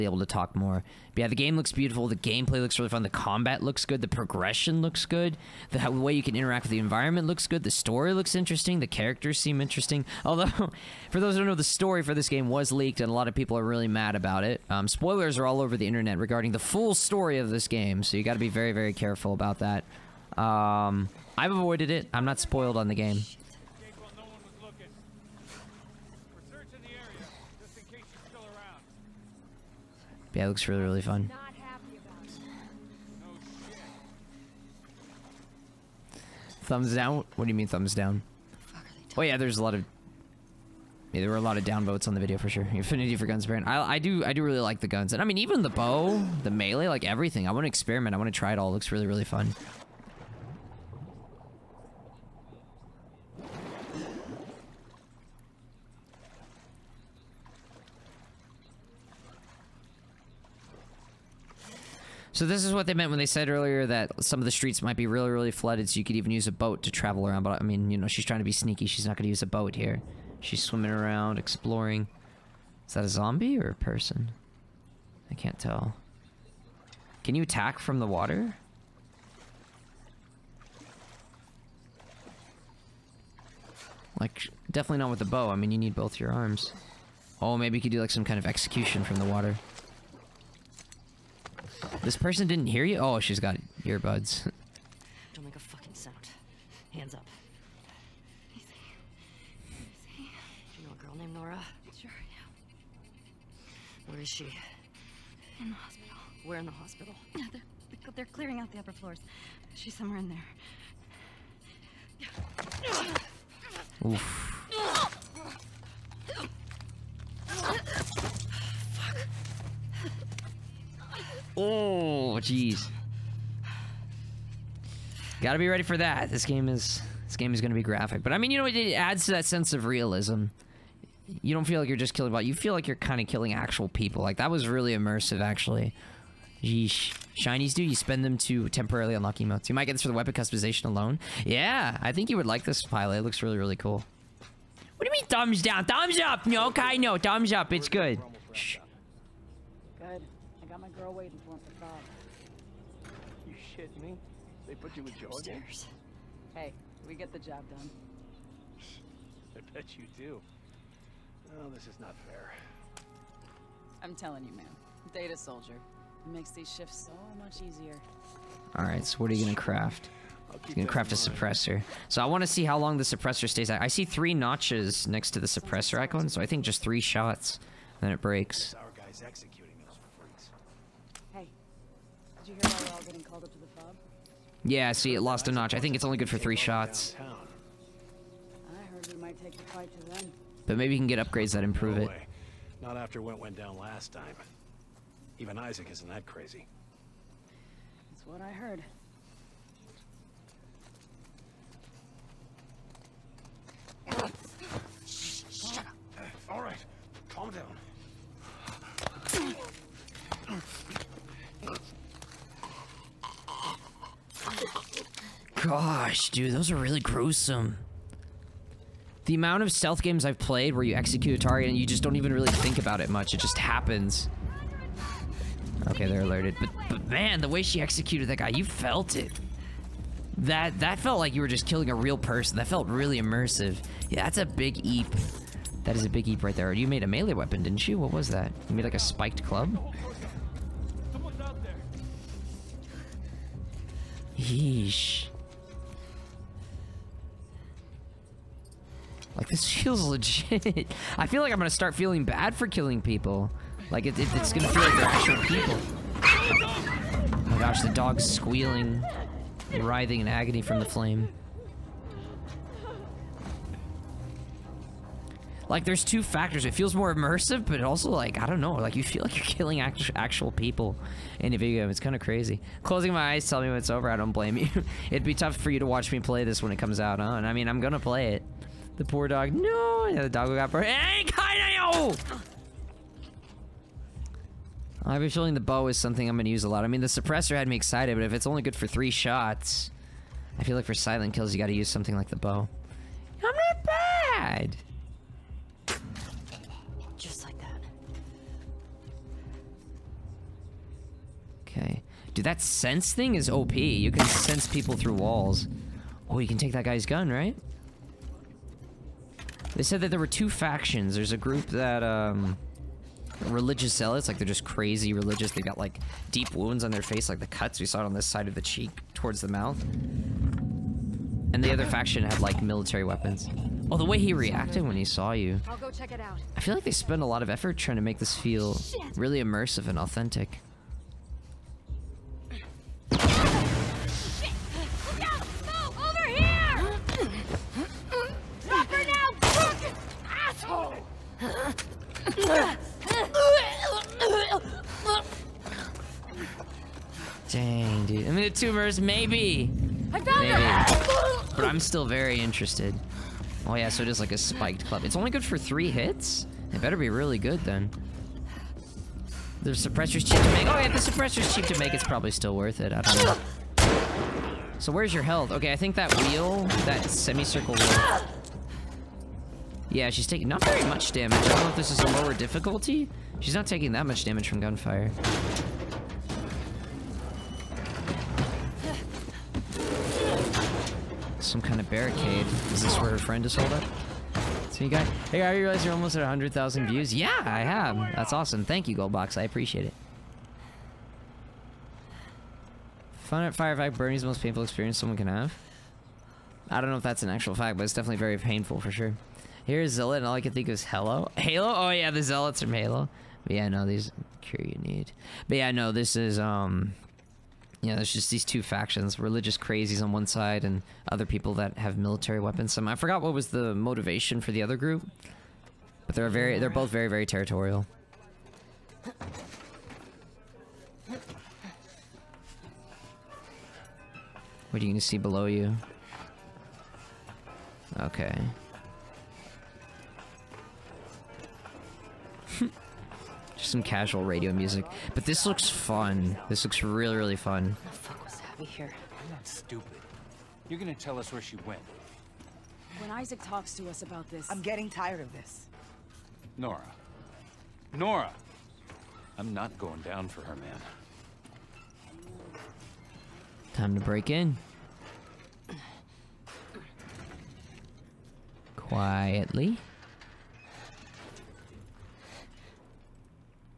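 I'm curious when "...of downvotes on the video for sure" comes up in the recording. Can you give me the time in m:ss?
0:41.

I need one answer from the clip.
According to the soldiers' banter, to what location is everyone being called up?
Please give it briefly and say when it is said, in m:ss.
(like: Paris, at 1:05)
The FOB, at 3:03.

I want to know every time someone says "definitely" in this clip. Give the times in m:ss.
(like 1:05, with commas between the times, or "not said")
1:24, 6:37.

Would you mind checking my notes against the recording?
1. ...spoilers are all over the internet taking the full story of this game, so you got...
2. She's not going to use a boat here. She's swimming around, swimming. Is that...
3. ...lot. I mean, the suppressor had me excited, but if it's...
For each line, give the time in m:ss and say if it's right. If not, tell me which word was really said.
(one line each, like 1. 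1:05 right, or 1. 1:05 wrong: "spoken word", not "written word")
1. 0:14 wrong: "regarding", not "taking"
2. 1:08 wrong: "exploring", not "swimming"
3. 4:46 right.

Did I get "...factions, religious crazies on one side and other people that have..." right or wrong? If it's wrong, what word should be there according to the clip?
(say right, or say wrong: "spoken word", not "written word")
right.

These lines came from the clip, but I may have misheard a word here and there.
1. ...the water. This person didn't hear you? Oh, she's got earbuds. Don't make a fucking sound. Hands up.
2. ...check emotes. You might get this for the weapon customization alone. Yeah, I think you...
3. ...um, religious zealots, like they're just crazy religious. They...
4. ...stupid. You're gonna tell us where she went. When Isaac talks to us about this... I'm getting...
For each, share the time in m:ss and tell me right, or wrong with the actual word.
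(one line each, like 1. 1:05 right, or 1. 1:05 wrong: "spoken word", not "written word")
1. 1:29 right
2. 2:19 wrong: "unlock", not "check"
3. 5:12 right
4. 7:19 right.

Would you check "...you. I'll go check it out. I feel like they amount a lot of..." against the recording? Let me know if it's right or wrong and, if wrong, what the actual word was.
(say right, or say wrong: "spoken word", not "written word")
wrong: "spent", not "amount".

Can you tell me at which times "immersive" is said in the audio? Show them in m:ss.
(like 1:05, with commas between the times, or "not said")
2:14, 3:53, 4:27, 5:29.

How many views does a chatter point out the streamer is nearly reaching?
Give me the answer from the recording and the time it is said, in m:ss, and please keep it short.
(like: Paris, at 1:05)
100,000, at 6:26.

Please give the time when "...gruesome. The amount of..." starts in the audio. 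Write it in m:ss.
3:36.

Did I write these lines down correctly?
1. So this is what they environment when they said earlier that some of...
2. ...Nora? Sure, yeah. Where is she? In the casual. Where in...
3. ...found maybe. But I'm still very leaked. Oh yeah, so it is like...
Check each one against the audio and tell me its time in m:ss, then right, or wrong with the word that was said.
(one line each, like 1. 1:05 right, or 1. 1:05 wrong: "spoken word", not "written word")
1. 1:02 wrong: "meant", not "environment"
2. 1:41 wrong: "hospital", not "casual"
3. 5:50 wrong: "interested", not "leaked".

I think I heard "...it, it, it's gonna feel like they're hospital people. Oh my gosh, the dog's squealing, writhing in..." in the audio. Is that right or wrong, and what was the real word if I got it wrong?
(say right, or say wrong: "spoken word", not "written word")
wrong: "actual", not "hospital".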